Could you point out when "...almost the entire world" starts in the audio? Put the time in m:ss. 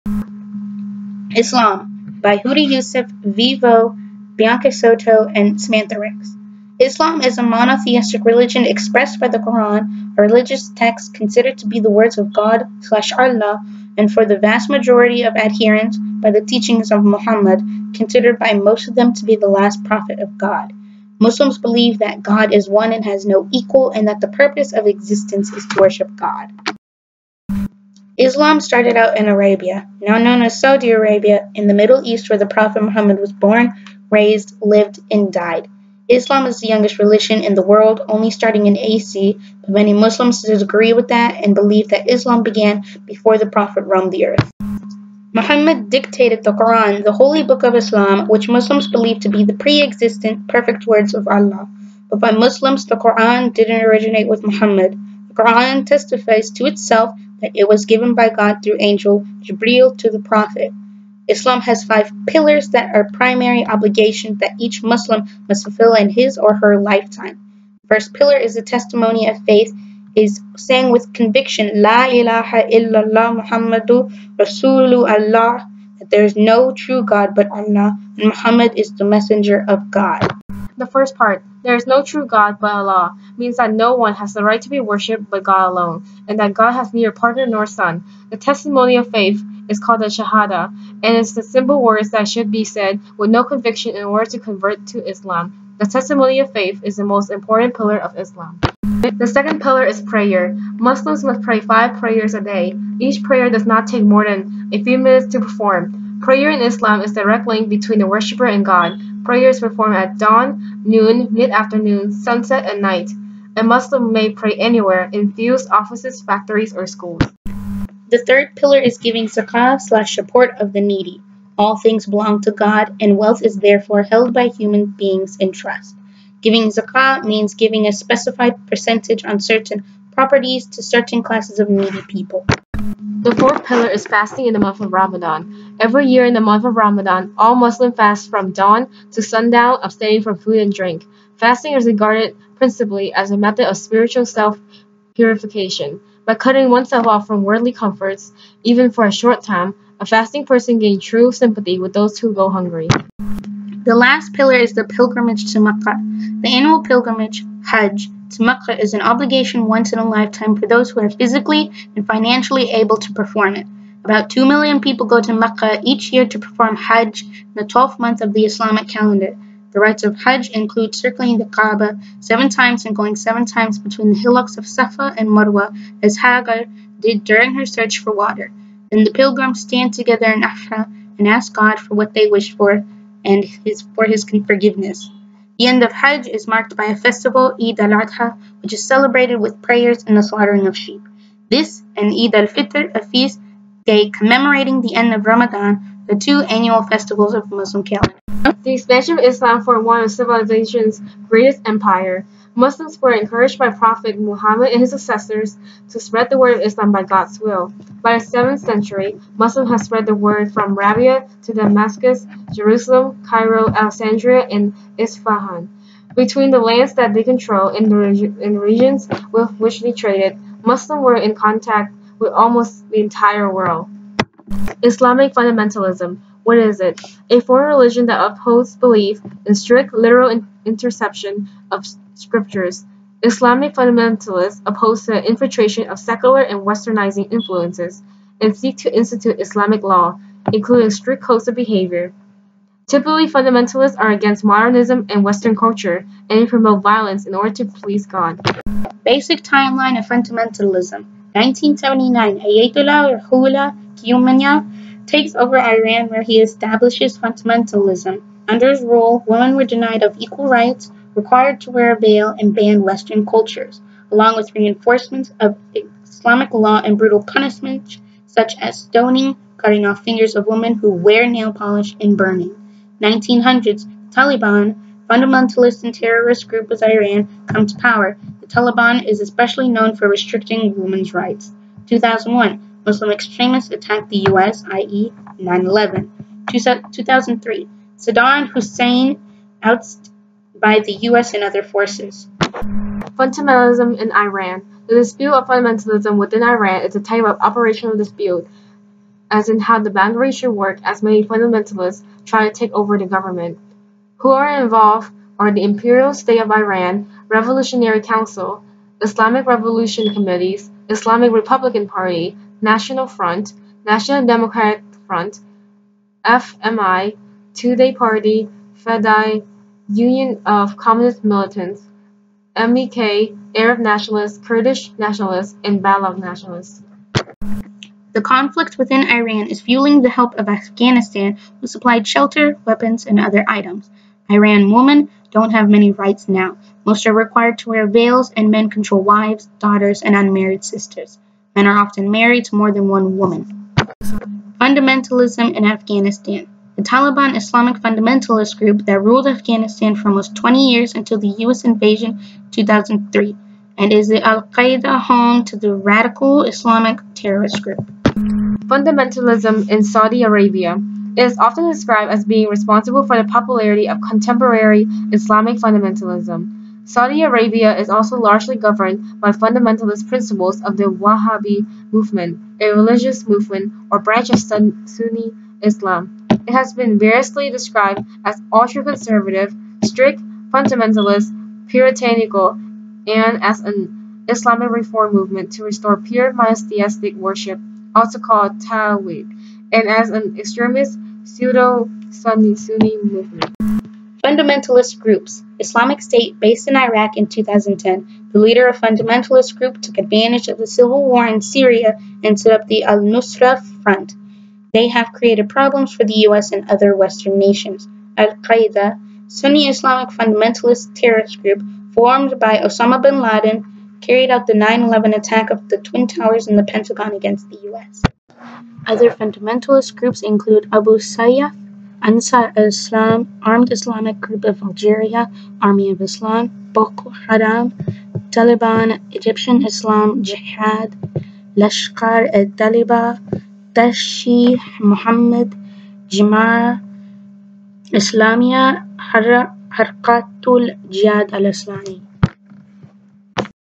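3:42.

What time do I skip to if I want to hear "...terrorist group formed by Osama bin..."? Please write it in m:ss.
6:50.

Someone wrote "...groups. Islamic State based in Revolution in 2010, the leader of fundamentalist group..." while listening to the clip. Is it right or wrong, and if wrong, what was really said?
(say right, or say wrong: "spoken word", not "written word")
wrong: "Iraq", not "Revolution".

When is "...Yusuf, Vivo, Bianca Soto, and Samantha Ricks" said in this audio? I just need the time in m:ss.
0:02.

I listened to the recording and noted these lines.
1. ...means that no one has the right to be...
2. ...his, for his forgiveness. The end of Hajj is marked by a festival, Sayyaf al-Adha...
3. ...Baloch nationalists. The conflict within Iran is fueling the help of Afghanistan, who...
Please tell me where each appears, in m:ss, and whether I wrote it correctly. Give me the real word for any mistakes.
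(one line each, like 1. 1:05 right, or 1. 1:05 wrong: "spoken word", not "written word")
1. 1:23 right
2. 3:03 wrong: "Eid", not "Sayyaf"
3. 5:25 right.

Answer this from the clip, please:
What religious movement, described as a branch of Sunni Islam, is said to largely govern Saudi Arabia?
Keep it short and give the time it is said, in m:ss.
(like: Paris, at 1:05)
Wahhabi movement, at 6:10.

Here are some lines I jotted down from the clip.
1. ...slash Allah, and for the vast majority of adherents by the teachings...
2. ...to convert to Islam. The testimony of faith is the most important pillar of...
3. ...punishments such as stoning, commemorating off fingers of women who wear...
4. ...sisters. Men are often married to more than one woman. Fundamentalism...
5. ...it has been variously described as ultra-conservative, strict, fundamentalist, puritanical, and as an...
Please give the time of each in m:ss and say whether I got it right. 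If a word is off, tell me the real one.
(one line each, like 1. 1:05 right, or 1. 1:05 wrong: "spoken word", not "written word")
1. 0:12 right
2. 1:34 right
3. 4:27 wrong: "cutting", not "commemorating"
4. 5:40 right
5. 6:16 right.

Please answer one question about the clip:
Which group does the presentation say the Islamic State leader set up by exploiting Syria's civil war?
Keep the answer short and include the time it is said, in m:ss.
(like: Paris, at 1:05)
Al-Nusra Front, at 6:42.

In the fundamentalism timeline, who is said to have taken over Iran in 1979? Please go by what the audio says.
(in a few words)
Ayatollah Ruhollah Khomeini.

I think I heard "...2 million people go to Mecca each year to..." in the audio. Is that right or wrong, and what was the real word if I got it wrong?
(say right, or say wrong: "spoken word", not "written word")
right.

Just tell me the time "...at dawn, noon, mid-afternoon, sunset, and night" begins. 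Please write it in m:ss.
1:49.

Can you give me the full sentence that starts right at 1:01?
Islam has five pillars that are primary obligations that each Muslim must fulfill in his or her lifetime.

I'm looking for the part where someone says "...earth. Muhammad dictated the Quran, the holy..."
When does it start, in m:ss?
0:44.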